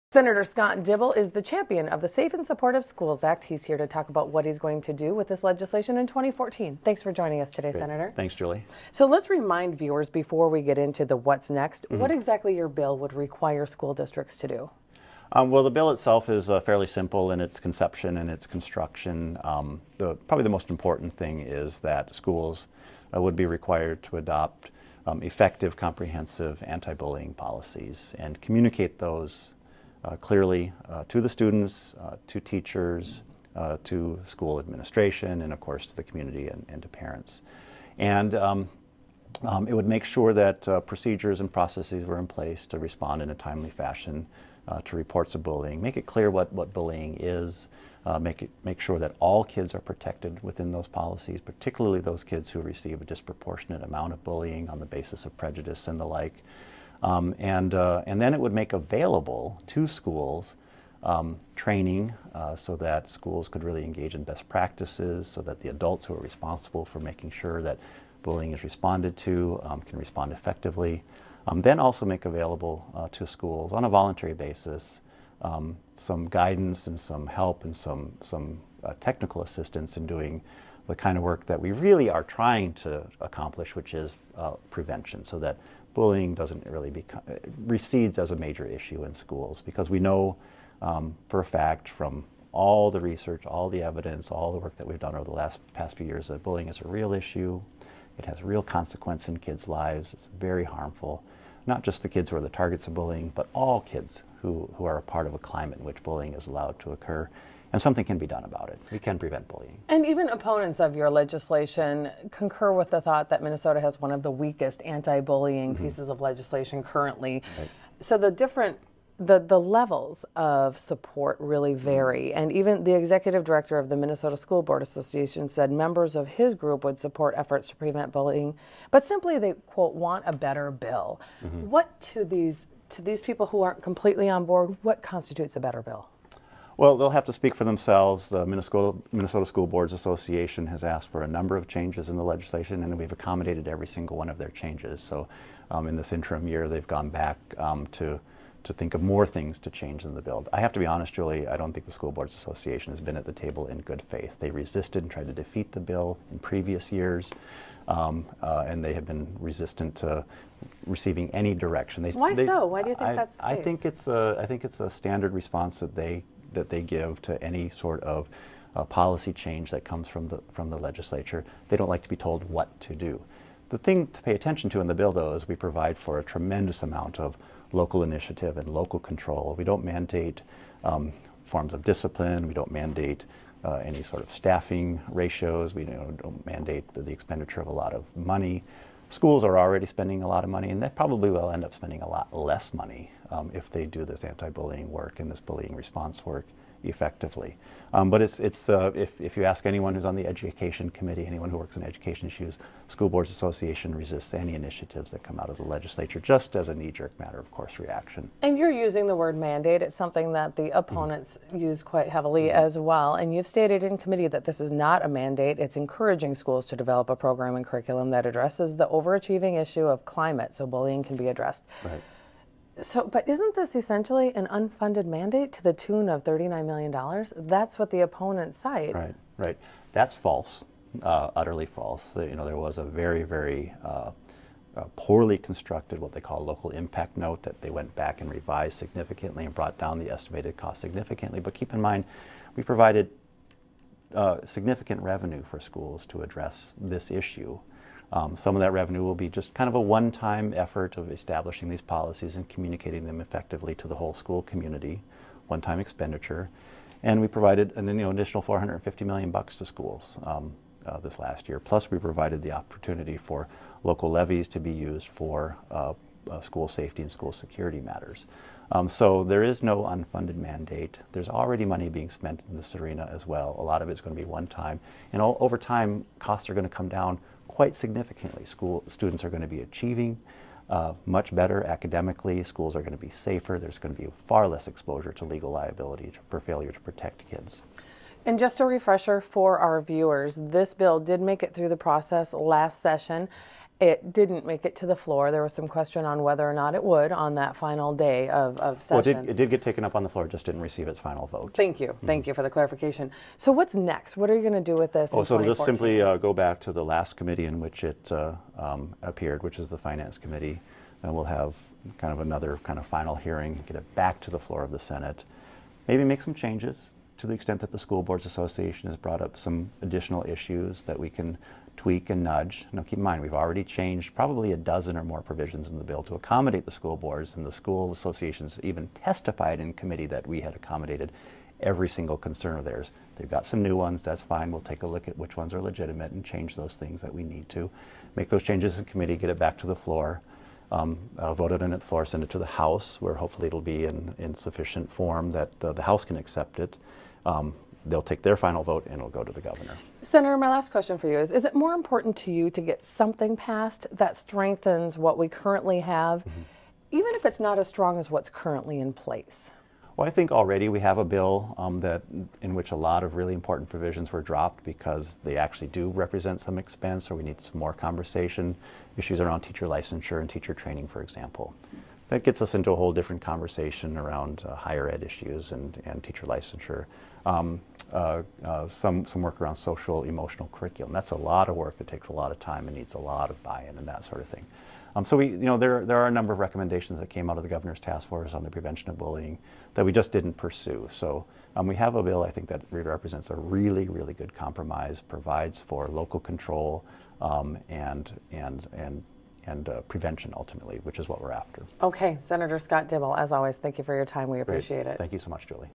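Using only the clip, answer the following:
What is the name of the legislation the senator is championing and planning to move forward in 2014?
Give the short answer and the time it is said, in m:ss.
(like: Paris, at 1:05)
Safe and Supportive Schools Act, at 0:02.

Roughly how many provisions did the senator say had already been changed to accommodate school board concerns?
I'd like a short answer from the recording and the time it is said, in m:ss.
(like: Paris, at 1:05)
a dozen, at 5:24.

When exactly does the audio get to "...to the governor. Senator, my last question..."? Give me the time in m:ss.
5:49.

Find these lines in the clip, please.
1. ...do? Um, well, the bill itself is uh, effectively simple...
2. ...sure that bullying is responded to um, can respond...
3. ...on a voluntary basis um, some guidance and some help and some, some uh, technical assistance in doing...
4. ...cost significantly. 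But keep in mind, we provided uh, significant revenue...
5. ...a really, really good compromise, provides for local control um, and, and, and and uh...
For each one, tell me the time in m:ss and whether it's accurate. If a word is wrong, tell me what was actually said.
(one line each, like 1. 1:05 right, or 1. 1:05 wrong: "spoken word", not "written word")
1. 0:14 wrong: "fairly", not "effectively"
2. 1:07 right
3. 1:13 right
4. 4:00 right
5. 6:33 right.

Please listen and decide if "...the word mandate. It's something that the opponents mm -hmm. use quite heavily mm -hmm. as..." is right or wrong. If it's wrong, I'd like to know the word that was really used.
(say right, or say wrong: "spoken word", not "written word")
right.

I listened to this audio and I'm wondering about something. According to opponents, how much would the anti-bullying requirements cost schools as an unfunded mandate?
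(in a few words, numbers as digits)
$39 million.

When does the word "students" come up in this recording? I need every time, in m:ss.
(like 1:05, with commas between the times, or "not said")
0:31, 4:38.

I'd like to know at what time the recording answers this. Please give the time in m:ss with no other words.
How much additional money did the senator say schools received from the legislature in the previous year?
4:18.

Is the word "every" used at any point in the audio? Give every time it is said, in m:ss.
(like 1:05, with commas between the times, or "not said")
2:23, 5:31.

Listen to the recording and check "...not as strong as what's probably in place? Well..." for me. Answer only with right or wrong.
wrong.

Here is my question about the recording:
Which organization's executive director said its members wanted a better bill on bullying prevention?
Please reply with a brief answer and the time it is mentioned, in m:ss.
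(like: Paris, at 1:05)
Minnesota School Board Association, at 2:03.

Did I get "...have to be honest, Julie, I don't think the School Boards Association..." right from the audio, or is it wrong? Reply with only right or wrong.
right.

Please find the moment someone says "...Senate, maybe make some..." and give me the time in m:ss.
5:14.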